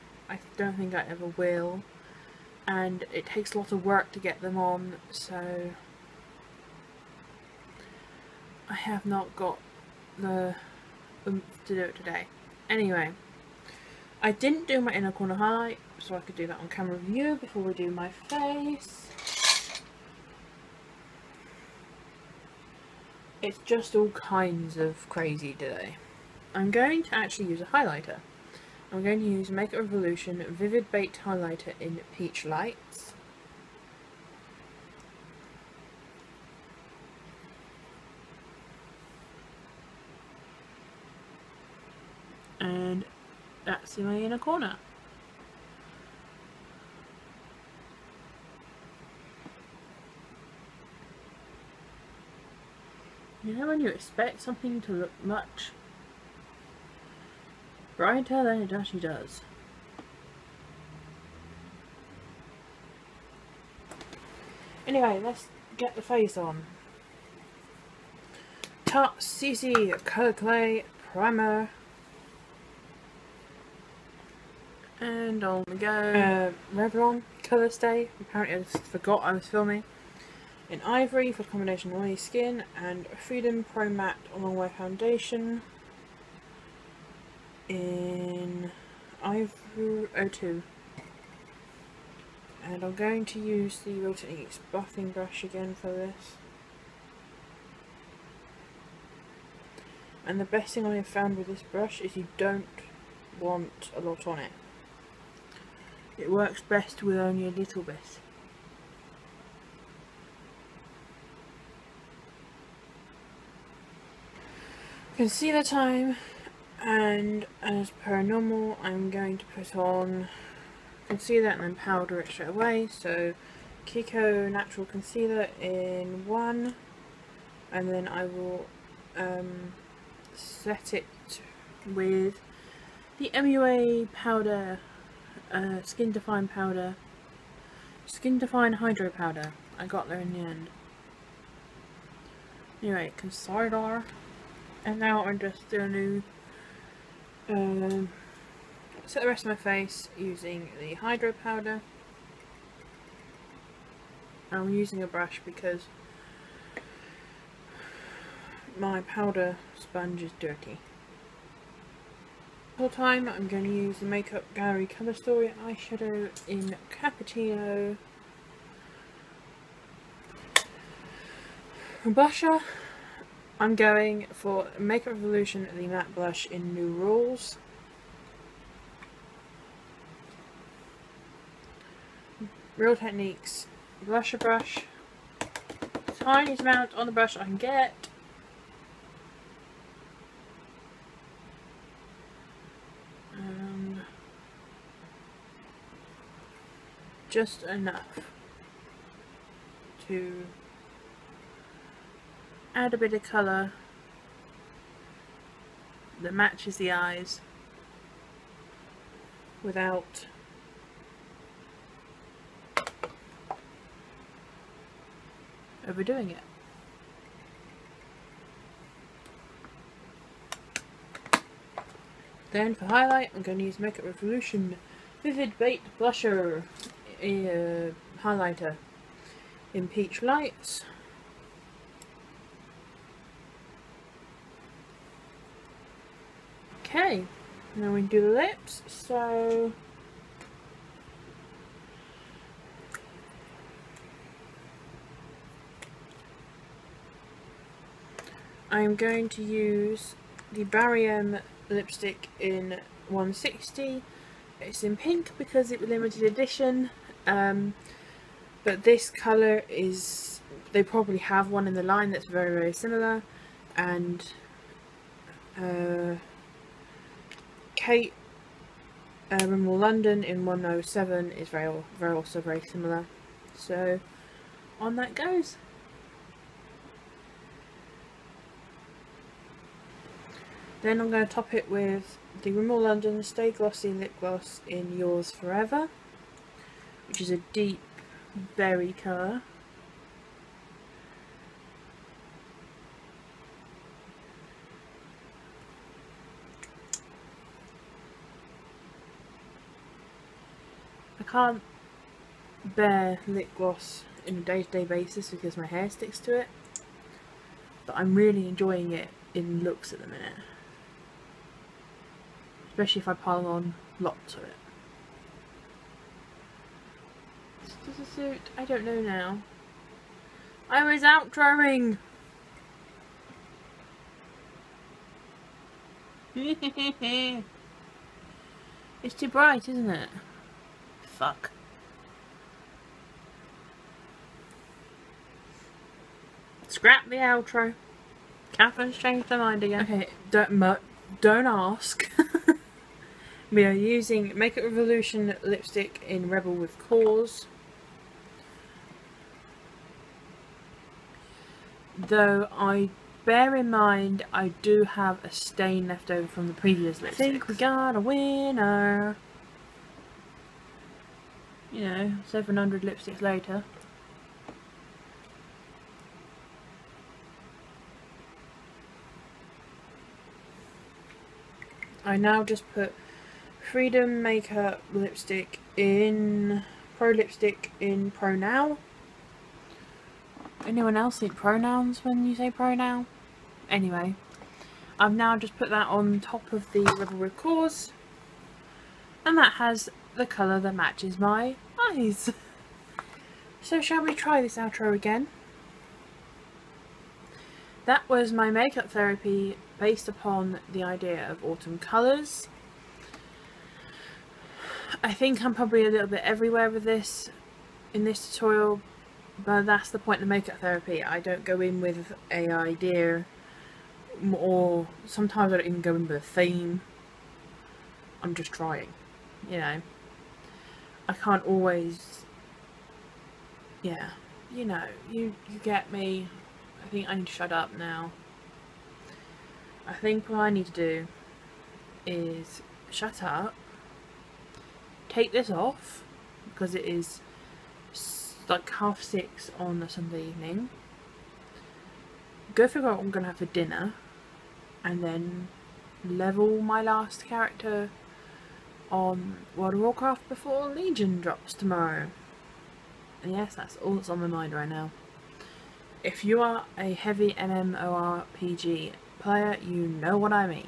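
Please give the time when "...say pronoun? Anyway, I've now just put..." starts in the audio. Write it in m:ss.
6:22.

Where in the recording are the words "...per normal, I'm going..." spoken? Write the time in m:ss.
1:58.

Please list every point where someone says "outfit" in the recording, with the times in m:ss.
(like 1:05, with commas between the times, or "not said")
not said.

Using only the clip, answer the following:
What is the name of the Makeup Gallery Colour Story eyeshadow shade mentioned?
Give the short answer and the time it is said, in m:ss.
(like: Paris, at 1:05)
Cappuccino, at 2:46.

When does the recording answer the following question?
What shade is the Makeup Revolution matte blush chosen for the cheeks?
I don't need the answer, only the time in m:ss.
2:56.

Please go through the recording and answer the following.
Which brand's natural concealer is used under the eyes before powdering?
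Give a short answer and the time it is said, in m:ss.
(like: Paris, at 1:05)
Kiko, at 2:03.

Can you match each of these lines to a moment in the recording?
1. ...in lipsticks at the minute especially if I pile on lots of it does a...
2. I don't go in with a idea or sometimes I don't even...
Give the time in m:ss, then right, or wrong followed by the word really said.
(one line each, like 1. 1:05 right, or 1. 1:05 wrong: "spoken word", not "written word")
1. 5:09 wrong: "looks", not "lipsticks"
2. 6:51 right.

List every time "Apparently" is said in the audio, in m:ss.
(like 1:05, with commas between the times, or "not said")
1:18.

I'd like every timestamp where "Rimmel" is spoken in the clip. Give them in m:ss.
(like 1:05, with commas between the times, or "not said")
4:29, 4:42.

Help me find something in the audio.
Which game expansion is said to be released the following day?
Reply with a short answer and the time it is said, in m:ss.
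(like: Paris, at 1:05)
Legion, at 7:30.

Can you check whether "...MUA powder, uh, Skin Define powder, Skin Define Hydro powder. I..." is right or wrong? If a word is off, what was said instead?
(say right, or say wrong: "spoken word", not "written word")
right.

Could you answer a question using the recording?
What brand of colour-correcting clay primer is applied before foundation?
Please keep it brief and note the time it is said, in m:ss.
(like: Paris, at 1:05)
Tarte, at 1:08.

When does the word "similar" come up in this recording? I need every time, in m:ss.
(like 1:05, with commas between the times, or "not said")
4:22, 4:32.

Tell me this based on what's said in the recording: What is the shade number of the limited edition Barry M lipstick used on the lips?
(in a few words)
160.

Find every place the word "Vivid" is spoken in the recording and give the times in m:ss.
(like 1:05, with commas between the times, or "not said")
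0:30, 3:45.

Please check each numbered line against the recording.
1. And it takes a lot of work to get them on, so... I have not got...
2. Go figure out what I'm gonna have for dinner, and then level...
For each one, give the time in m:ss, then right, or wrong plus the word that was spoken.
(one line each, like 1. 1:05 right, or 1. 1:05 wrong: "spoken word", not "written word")
1. 0:02 right
2. 7:22 right.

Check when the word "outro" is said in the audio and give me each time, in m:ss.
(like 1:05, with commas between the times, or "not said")
5:37, 6:34.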